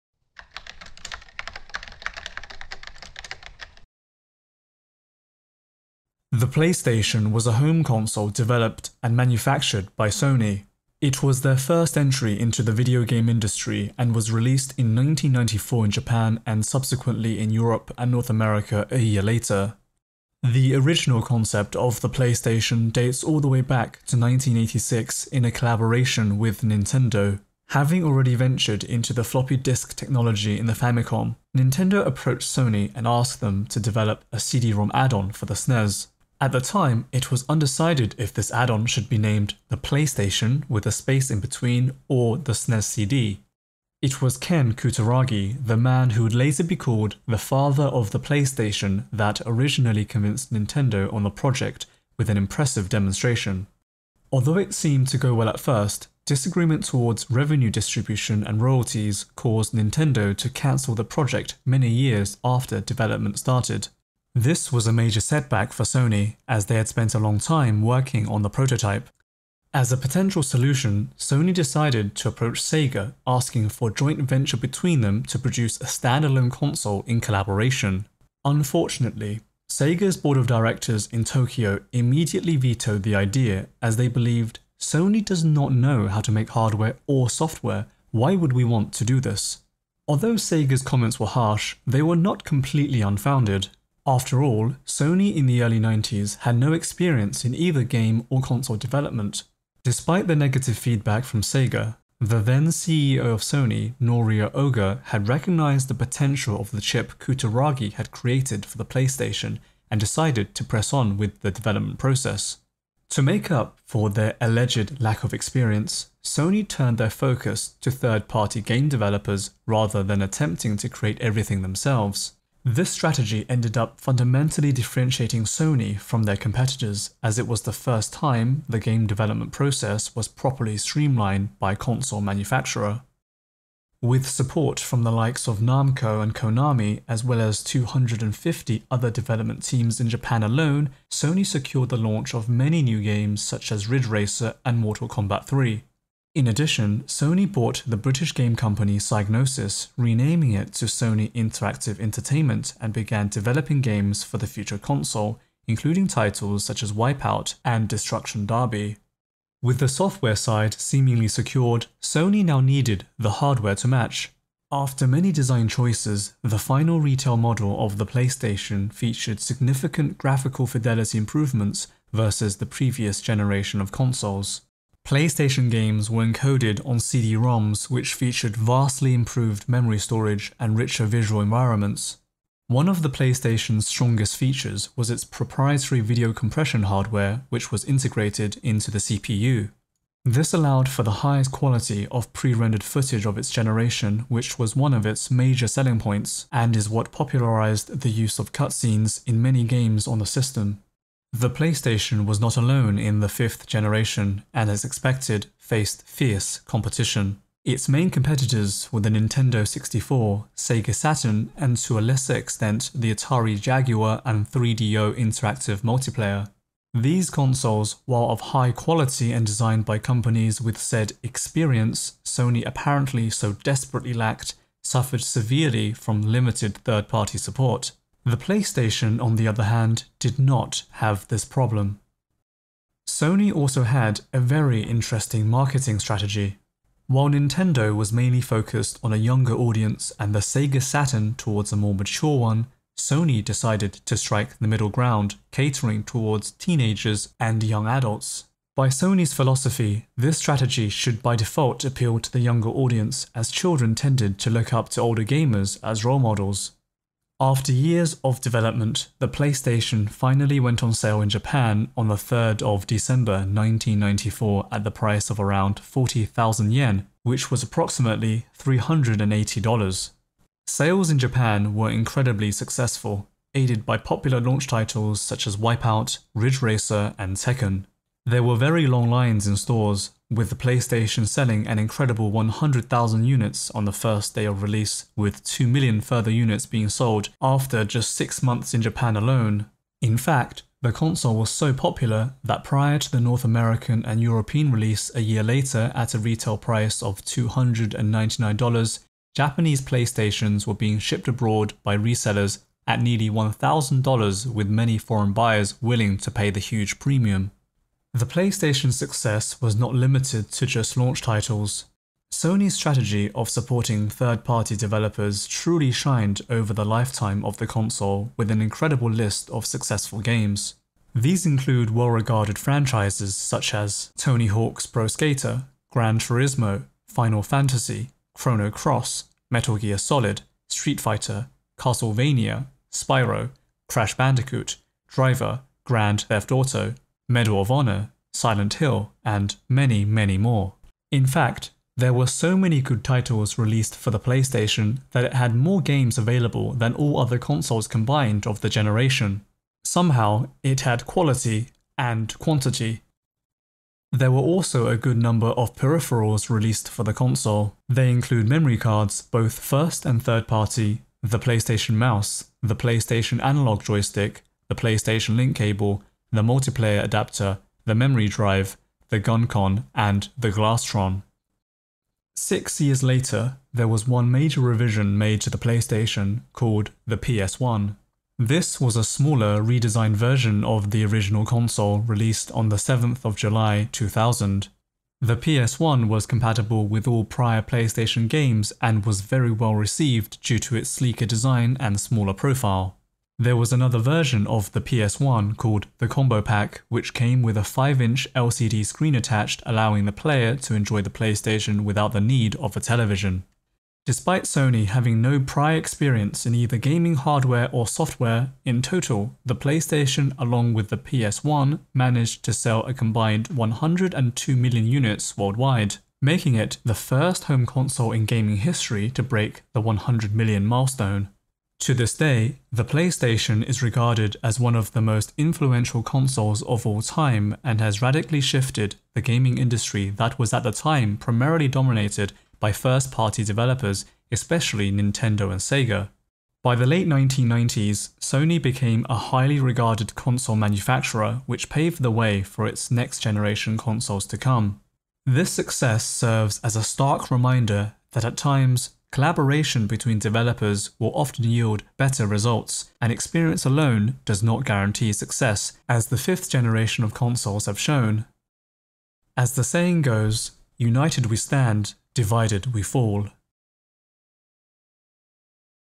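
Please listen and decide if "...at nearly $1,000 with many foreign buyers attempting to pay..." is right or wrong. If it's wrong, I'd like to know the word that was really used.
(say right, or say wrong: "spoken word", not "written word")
wrong: "willing", not "attempting".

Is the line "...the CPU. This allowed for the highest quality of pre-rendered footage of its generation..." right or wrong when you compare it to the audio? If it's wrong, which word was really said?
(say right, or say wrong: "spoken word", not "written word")
right.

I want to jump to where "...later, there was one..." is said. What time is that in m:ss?
6:13.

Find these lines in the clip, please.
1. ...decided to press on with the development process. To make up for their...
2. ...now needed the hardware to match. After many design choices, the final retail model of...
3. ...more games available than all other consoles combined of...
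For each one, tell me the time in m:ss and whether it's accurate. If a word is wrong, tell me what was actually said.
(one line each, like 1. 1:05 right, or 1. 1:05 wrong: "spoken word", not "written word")
1. 1:49 right
2. 2:42 right
3. 5:45 right.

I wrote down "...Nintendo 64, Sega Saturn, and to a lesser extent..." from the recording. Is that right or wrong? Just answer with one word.
right.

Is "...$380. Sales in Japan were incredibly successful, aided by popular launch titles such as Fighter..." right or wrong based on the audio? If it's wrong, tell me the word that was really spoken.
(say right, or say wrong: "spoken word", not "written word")
wrong: "Wipeout", not "Fighter".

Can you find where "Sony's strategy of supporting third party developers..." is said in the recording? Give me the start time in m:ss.
5:12.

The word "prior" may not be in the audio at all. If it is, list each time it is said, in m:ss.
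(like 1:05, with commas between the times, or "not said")
4:52, 6:27, 6:45.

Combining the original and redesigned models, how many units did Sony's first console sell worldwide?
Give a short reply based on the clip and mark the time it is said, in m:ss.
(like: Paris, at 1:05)
102 million, at 6:53.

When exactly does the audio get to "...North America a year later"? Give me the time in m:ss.
0:18.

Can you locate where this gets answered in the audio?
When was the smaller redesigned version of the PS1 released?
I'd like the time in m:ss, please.
6:22.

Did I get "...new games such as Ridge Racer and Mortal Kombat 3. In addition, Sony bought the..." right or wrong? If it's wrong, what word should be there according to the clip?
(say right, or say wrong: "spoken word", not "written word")
right.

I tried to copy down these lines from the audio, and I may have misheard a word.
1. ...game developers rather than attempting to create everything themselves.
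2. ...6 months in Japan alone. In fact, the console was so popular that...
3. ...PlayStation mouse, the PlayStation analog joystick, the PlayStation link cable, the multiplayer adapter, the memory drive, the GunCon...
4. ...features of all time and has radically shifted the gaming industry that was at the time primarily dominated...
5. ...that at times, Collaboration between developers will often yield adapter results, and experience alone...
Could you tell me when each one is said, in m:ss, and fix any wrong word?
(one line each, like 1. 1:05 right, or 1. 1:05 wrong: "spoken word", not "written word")
1. 1:58 right
2. 4:48 right
3. 6:01 right
4. 7:06 wrong: "consoles", not "features"
5. 7:28 wrong: "better", not "adapter".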